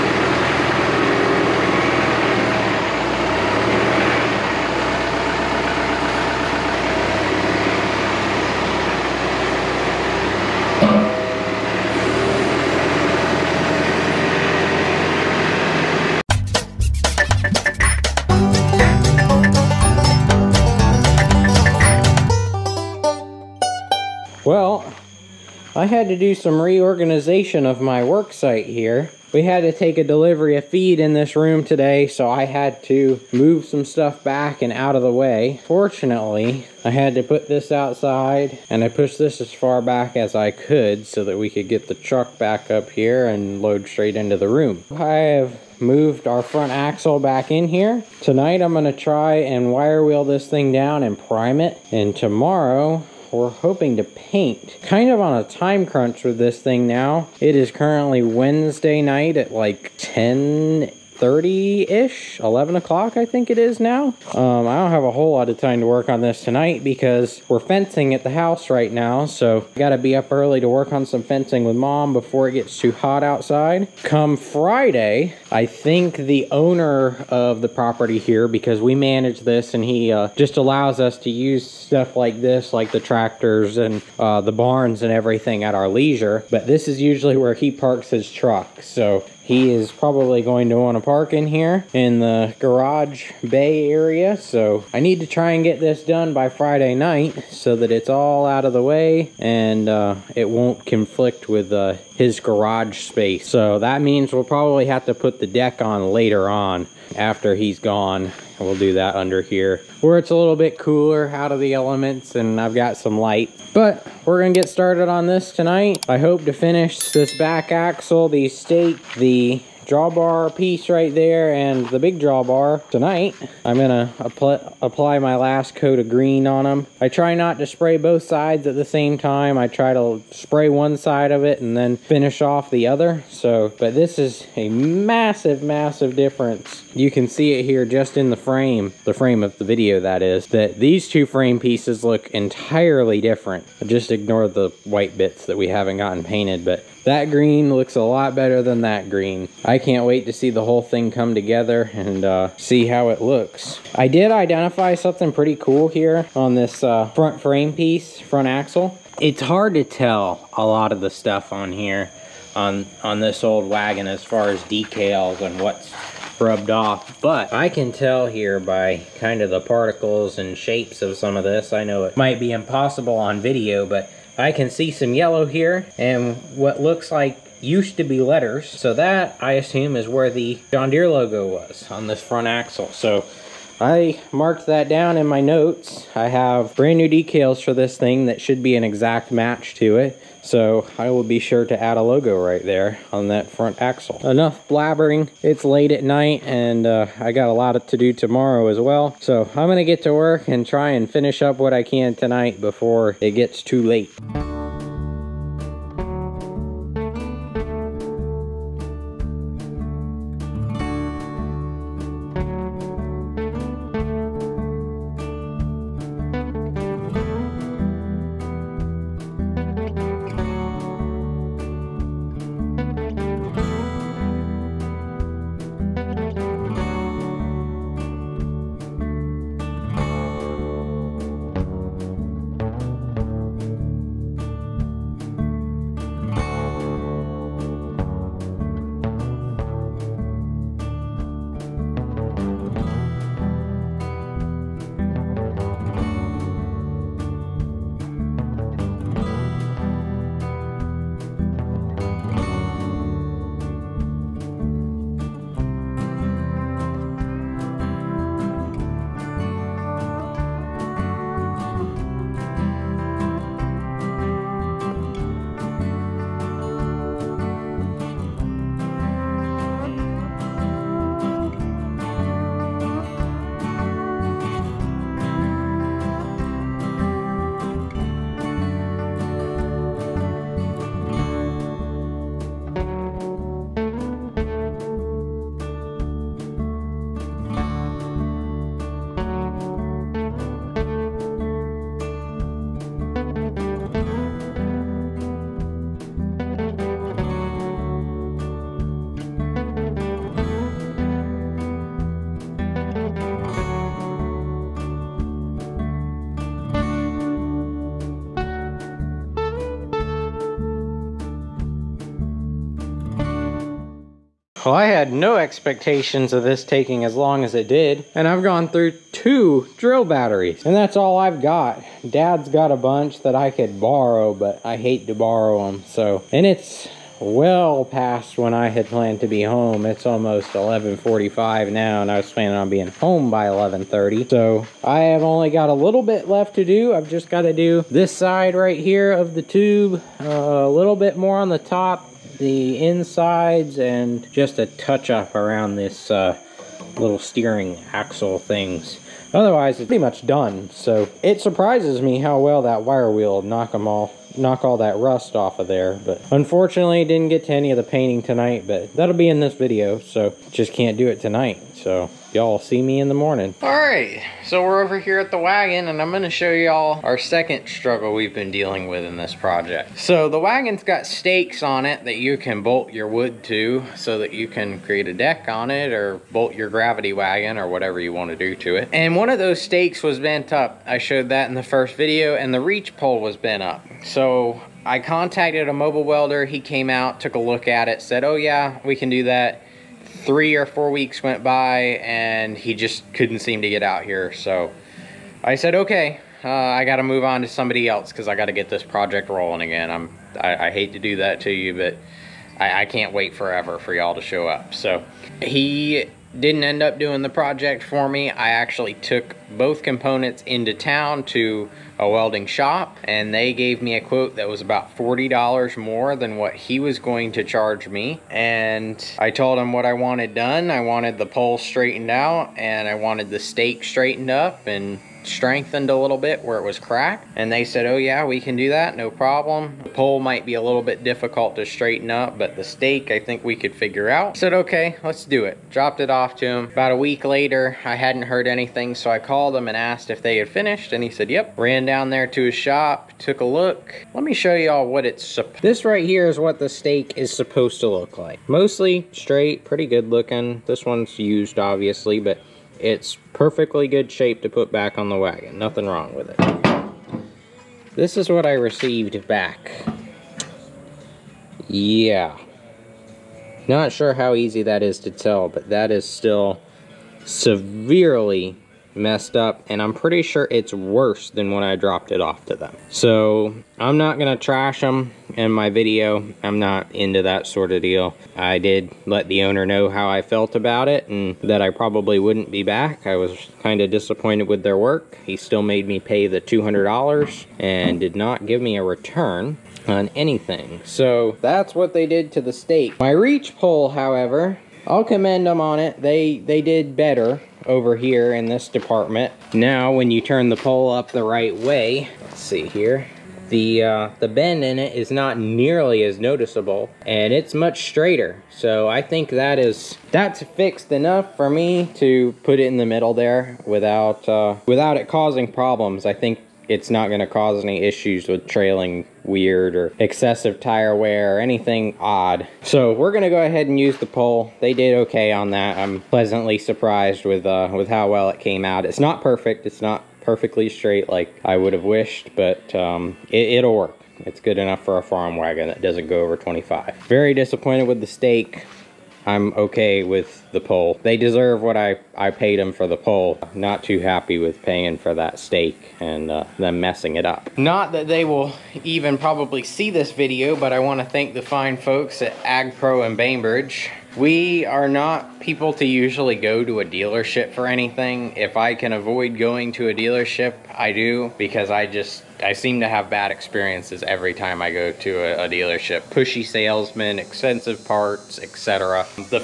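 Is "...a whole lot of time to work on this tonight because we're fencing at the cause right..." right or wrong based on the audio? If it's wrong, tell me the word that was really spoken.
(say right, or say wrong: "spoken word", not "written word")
wrong: "house", not "cause".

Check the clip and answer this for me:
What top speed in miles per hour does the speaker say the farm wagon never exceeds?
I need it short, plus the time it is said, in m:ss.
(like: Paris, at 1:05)
25, at 8:56.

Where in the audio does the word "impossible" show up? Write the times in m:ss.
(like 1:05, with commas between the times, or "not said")
2:52.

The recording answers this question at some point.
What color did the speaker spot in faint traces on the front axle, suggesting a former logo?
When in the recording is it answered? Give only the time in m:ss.
2:55.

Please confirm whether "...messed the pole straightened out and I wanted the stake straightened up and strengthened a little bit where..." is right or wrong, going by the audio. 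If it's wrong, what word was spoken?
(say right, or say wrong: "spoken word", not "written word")
wrong: "wanted", not "messed".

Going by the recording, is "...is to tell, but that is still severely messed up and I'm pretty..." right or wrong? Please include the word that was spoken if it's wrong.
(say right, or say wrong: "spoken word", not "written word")
right.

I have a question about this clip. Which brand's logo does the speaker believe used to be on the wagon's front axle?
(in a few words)
John Deere.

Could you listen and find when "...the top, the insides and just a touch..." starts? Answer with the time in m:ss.
5:41.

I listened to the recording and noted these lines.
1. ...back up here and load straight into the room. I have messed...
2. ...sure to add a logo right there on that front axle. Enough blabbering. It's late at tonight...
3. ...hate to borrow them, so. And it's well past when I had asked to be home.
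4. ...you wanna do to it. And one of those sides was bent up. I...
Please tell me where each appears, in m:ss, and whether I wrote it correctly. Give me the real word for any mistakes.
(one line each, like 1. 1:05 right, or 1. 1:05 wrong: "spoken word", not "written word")
1. 0:42 wrong: "moved", not "messed"
2. 3:11 wrong: "night", not "tonight"
3. 5:24 wrong: "planned", not "asked"
4. 6:18 wrong: "stakes", not "sides".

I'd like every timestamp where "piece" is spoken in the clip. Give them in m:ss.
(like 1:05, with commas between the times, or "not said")
2:00, 2:21, 2:37.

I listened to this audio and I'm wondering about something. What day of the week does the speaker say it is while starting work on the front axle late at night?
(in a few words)
Wednesday.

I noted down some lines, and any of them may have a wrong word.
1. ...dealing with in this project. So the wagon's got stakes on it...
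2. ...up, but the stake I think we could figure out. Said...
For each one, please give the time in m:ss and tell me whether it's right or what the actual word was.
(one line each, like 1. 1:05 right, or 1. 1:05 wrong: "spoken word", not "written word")
1. 6:08 right
2. 7:12 right.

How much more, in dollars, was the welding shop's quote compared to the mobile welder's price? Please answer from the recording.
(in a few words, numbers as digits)
$40.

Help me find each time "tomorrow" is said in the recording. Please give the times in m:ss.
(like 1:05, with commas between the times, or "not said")
0:52, 3:18.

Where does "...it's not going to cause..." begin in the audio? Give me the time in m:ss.
8:36.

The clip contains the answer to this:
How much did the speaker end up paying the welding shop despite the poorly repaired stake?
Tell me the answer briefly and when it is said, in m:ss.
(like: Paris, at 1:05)
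$200, at 8:06.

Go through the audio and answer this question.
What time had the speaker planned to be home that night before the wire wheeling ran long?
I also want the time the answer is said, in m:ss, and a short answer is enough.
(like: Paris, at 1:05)
11:30, at 5:33.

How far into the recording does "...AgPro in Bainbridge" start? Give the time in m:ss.
9:12.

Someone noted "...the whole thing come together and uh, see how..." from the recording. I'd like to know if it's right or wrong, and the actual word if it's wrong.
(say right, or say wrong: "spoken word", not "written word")
right.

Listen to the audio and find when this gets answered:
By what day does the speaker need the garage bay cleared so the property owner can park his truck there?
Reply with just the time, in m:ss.
1:36.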